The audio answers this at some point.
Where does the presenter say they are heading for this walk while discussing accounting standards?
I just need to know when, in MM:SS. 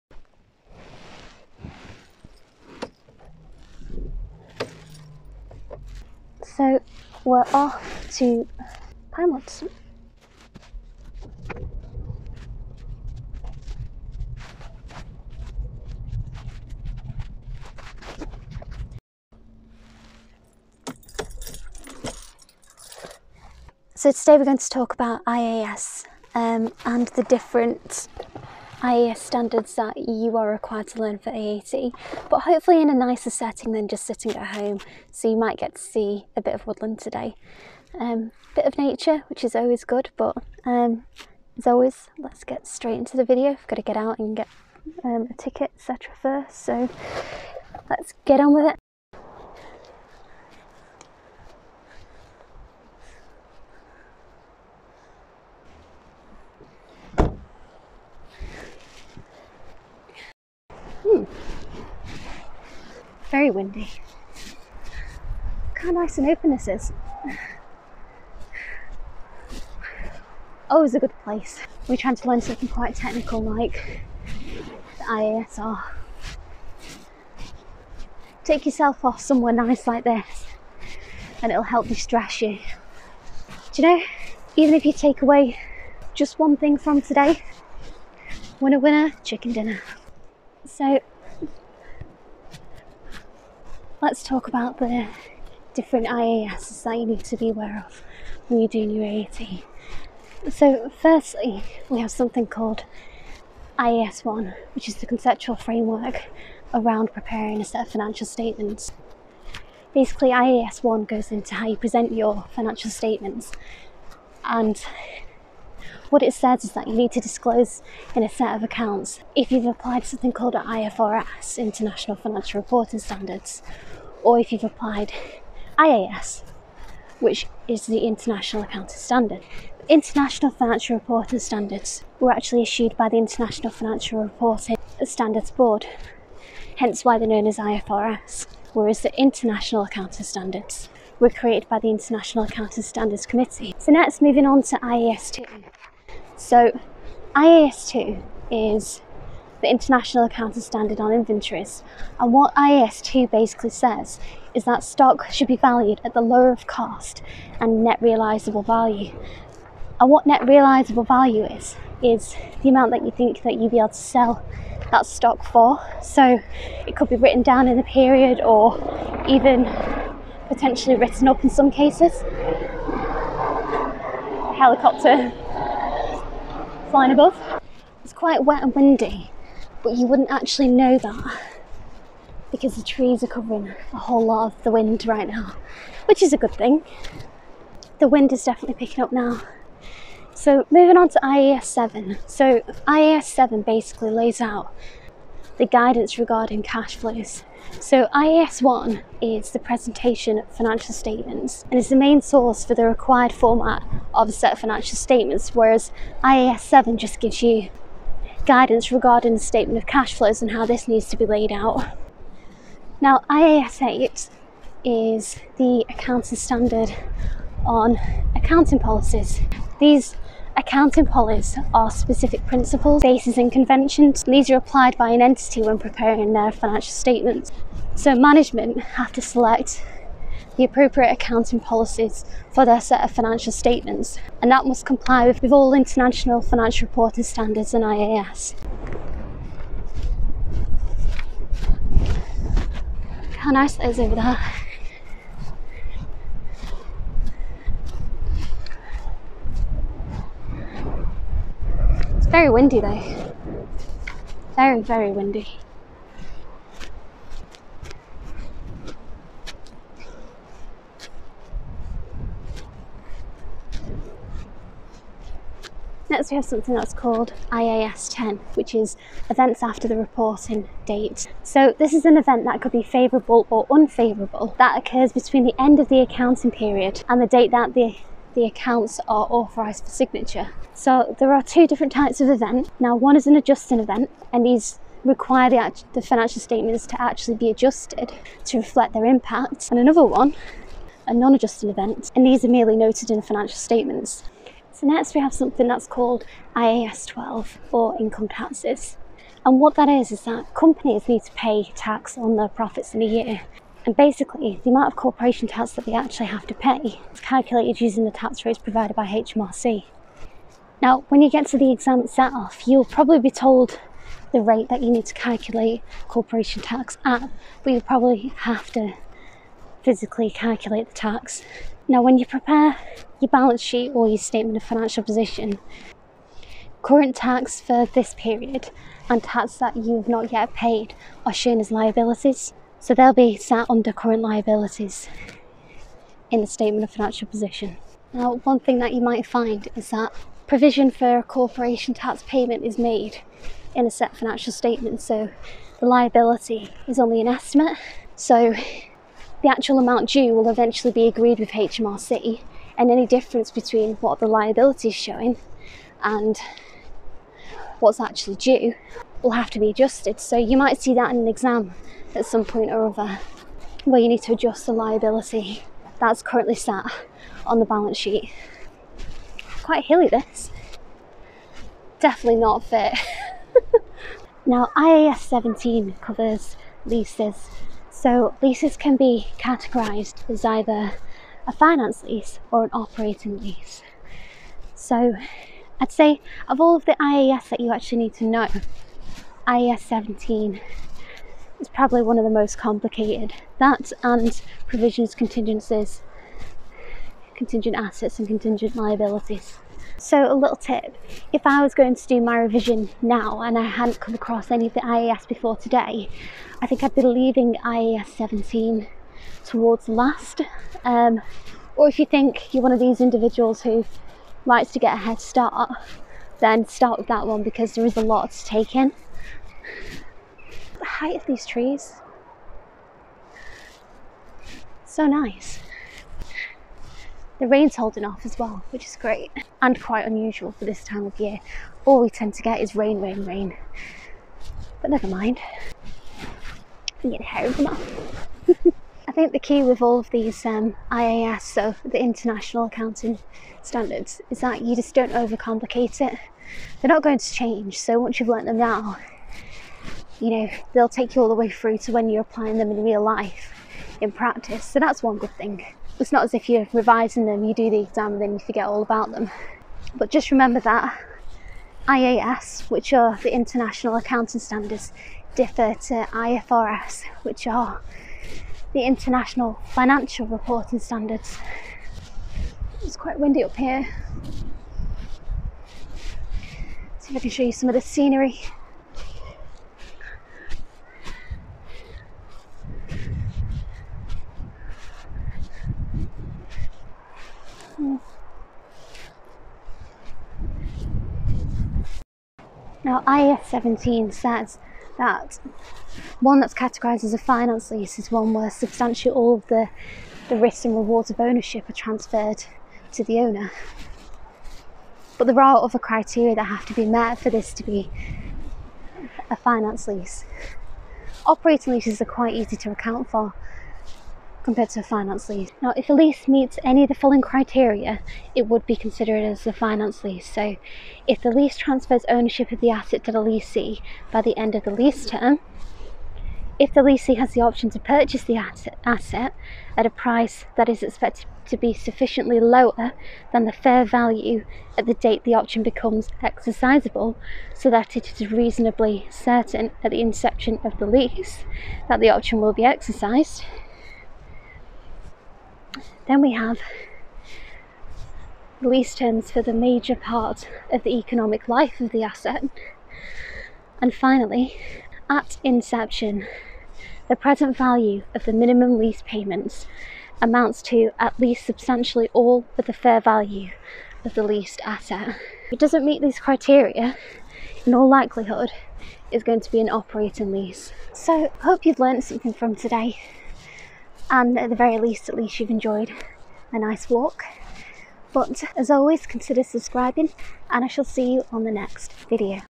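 00:09.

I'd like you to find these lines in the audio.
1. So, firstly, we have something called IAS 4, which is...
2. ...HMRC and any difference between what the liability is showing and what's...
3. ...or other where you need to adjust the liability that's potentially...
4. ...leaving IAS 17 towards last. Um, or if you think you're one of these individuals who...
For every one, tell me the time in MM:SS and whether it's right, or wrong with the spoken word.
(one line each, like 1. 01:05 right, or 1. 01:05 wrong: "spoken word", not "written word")
1. 01:40 wrong: "1", not "4"
2. 05:51 right
3. 06:02 wrong: "currently", not "potentially"
4. 06:47 right.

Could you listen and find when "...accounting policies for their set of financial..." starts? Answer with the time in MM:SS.
03:51.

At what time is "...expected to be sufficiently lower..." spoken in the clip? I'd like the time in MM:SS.
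08:50.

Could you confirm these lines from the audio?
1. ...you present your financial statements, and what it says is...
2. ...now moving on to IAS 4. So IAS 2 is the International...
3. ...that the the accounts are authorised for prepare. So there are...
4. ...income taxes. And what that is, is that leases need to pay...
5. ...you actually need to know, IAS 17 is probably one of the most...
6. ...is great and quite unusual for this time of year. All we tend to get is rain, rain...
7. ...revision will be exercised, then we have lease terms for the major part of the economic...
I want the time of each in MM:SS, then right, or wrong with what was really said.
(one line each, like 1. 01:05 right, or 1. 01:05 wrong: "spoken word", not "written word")
1. 01:51 right
2. 02:23 wrong: "2", not "4"
3. 04:37 wrong: "signature", not "prepare"
4. 04:57 wrong: "companies", not "leases"
5. 06:27 right
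6. 07:08 right
7. 09:02 wrong: "option", not "revision".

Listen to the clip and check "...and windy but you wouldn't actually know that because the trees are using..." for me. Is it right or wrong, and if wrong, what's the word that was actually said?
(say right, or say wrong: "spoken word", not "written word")
wrong: "covering", not "using".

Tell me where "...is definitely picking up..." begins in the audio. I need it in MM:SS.
03:08.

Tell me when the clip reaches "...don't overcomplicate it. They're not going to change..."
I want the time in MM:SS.
07:24.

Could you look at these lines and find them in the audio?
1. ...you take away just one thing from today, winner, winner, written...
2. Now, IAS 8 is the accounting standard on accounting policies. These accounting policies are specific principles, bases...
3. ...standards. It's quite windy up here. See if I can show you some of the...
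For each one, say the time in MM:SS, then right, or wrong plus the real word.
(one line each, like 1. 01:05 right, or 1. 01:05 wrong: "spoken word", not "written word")
1. 01:24 wrong: "chicken", not "written"
2. 03:32 right
3. 07:50 right.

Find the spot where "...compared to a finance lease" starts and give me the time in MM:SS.
08:34.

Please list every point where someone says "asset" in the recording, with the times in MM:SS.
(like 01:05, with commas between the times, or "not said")
06:37, 08:42, 08:48, 09:12, 09:24.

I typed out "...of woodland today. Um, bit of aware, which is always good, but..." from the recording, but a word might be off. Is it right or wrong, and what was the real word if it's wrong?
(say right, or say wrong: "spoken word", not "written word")
wrong: "nature", not "aware".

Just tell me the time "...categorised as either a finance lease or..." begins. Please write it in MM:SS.
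06:19.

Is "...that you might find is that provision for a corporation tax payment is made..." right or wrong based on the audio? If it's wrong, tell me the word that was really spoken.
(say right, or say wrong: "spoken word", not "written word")
right.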